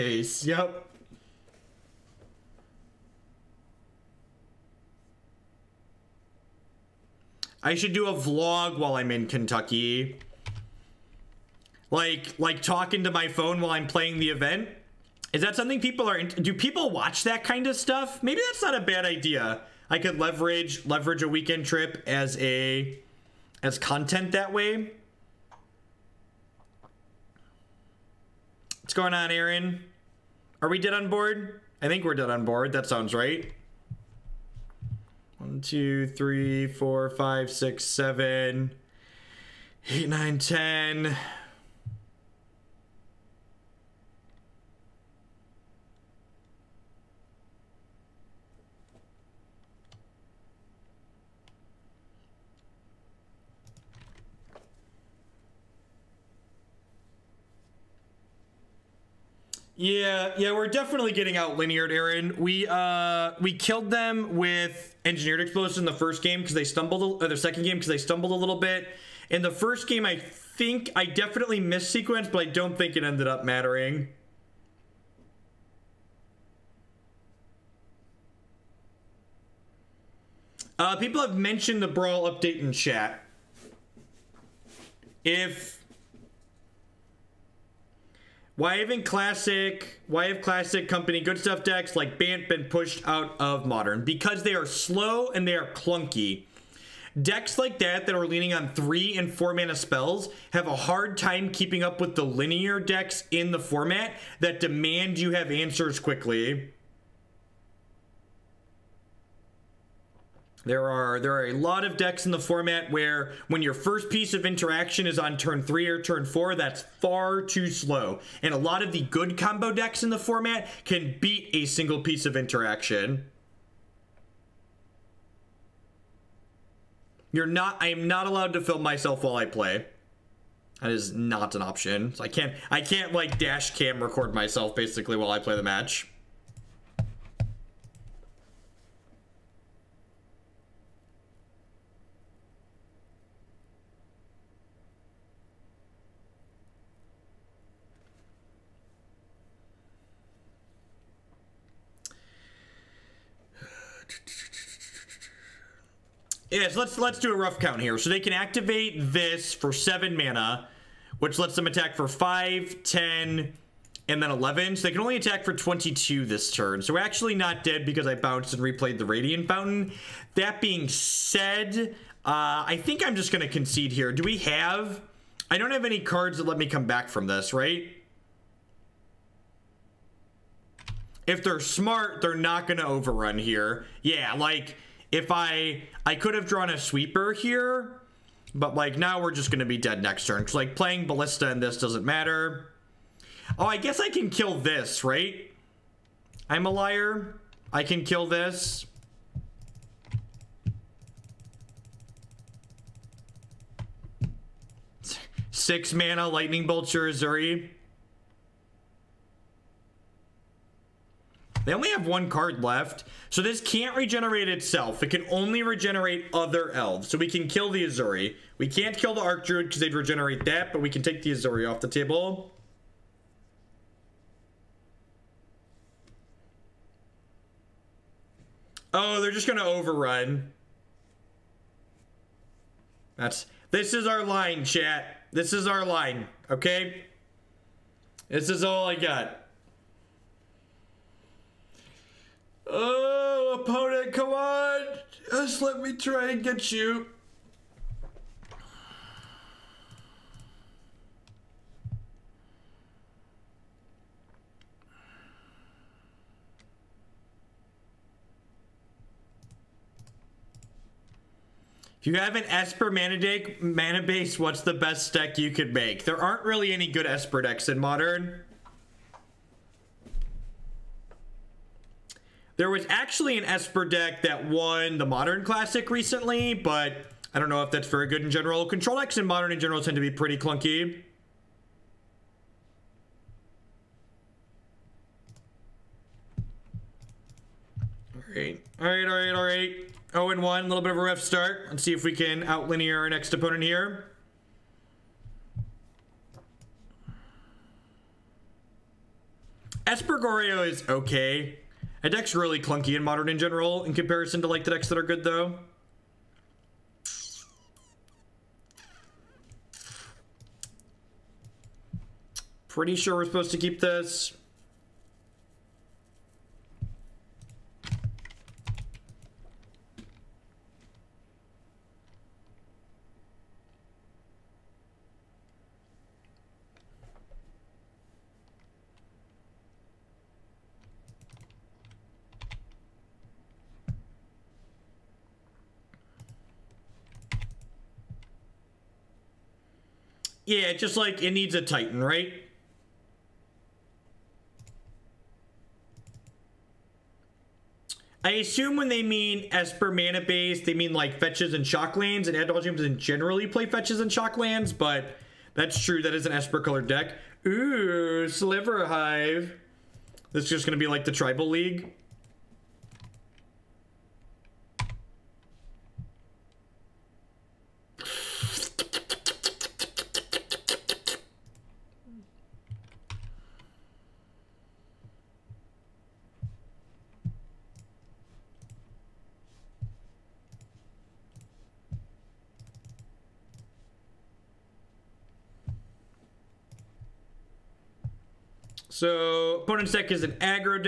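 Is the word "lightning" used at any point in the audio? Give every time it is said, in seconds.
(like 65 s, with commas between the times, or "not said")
206 s.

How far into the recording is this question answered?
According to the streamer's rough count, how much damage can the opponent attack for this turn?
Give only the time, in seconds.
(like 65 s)
165 s.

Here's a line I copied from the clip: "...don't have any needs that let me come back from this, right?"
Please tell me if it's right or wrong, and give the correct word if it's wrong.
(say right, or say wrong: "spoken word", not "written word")
wrong: "cards", not "needs".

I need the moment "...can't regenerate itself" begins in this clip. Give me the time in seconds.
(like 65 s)
213 s.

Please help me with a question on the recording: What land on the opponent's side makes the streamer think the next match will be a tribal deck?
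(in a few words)
Sliver Hive.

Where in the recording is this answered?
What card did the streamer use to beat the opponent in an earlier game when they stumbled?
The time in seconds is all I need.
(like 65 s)
65 s.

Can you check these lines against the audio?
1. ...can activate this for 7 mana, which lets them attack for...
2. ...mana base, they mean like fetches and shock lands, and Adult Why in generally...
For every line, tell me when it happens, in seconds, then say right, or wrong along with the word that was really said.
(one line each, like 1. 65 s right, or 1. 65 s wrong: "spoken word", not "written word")
1. 158 s right
2. 349 s wrong: "Gyms", not "Why".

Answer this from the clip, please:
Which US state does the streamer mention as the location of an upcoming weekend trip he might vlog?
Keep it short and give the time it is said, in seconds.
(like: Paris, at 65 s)
Kentucky, at 9 s.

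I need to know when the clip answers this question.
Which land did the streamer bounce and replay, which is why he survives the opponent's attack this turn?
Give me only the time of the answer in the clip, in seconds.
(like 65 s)
169 s.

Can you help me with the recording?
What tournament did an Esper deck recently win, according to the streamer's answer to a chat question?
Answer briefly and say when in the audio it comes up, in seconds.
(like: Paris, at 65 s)
Modern Classic, at 275 s.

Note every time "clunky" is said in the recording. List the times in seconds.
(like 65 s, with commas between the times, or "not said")
95 s, 280 s, 302 s.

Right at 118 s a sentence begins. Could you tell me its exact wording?
And a lot of the good combo decks in the format can beat a single piece of interaction.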